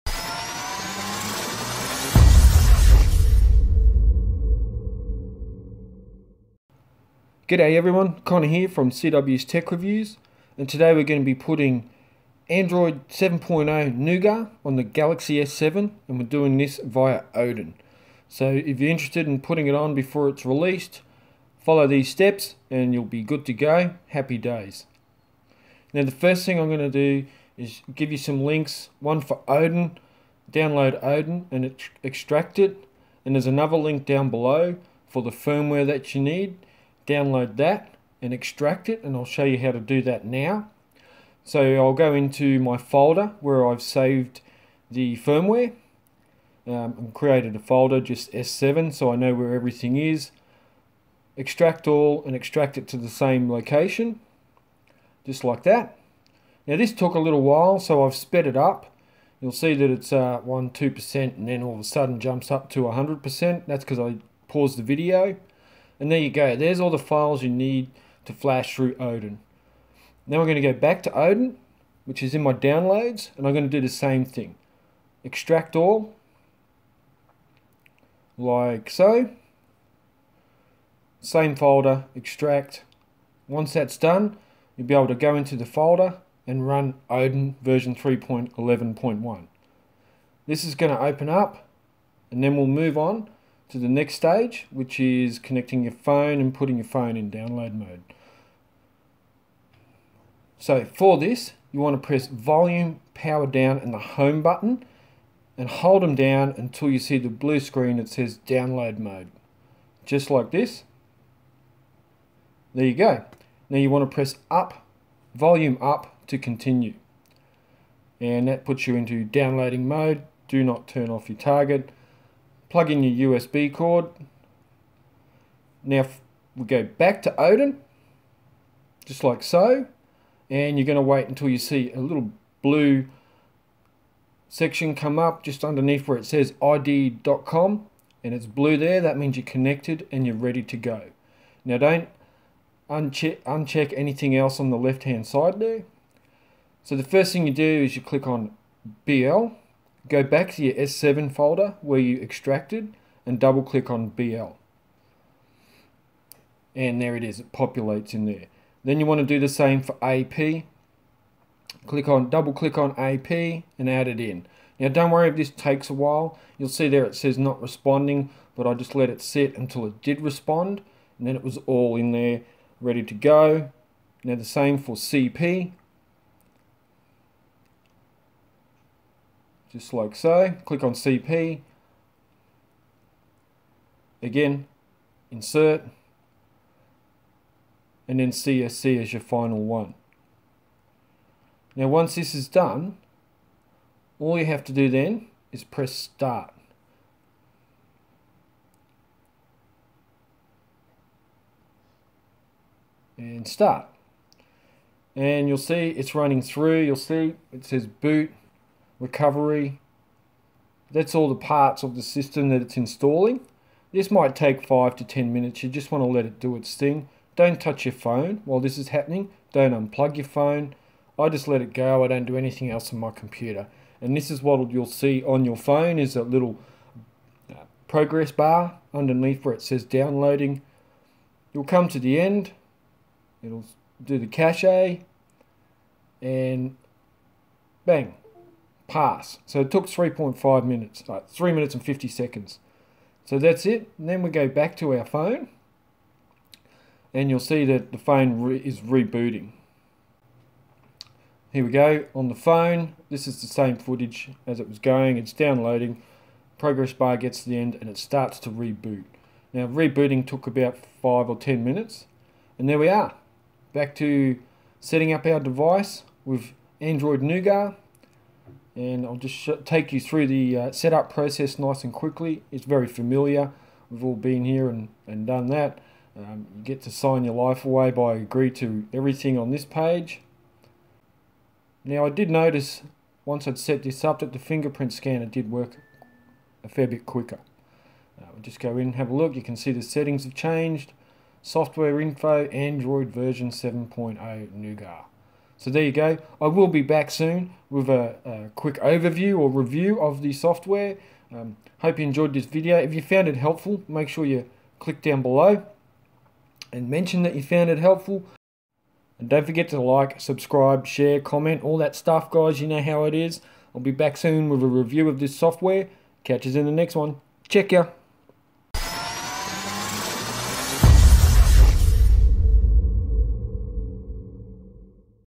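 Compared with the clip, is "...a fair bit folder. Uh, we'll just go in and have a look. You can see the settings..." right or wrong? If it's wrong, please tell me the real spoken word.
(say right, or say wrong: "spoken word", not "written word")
wrong: "quicker", not "folder".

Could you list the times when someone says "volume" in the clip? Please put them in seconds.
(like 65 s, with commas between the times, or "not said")
102 s, 115 s.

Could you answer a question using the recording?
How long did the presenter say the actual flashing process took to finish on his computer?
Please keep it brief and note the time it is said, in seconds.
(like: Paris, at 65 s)
3 minutes 50 seconds, at 241 s.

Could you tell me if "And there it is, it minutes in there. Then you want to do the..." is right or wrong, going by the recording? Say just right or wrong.
wrong.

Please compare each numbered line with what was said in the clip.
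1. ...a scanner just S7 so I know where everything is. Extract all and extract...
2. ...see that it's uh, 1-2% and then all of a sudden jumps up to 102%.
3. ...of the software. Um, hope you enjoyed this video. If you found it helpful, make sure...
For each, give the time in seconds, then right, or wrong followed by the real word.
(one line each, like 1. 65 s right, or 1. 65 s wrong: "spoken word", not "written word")
1. 47 s wrong: "folder", not "scanner"
2. 59 s wrong: "100", not "102"
3. 300 s right.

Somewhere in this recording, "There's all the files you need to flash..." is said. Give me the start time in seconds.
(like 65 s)
66 s.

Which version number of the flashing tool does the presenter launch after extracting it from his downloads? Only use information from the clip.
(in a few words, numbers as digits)
3.11.1.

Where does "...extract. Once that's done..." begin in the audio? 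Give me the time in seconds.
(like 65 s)
82 s.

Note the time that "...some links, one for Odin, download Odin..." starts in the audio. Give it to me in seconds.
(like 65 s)
28 s.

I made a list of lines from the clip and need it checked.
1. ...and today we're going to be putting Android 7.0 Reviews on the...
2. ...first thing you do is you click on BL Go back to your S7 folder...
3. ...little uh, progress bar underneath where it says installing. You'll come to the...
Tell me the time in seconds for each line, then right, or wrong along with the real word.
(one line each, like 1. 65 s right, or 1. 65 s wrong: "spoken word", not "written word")
1. 10 s wrong: "Nougat", not "Reviews"
2. 147 s right
3. 226 s wrong: "downloading", not "installing".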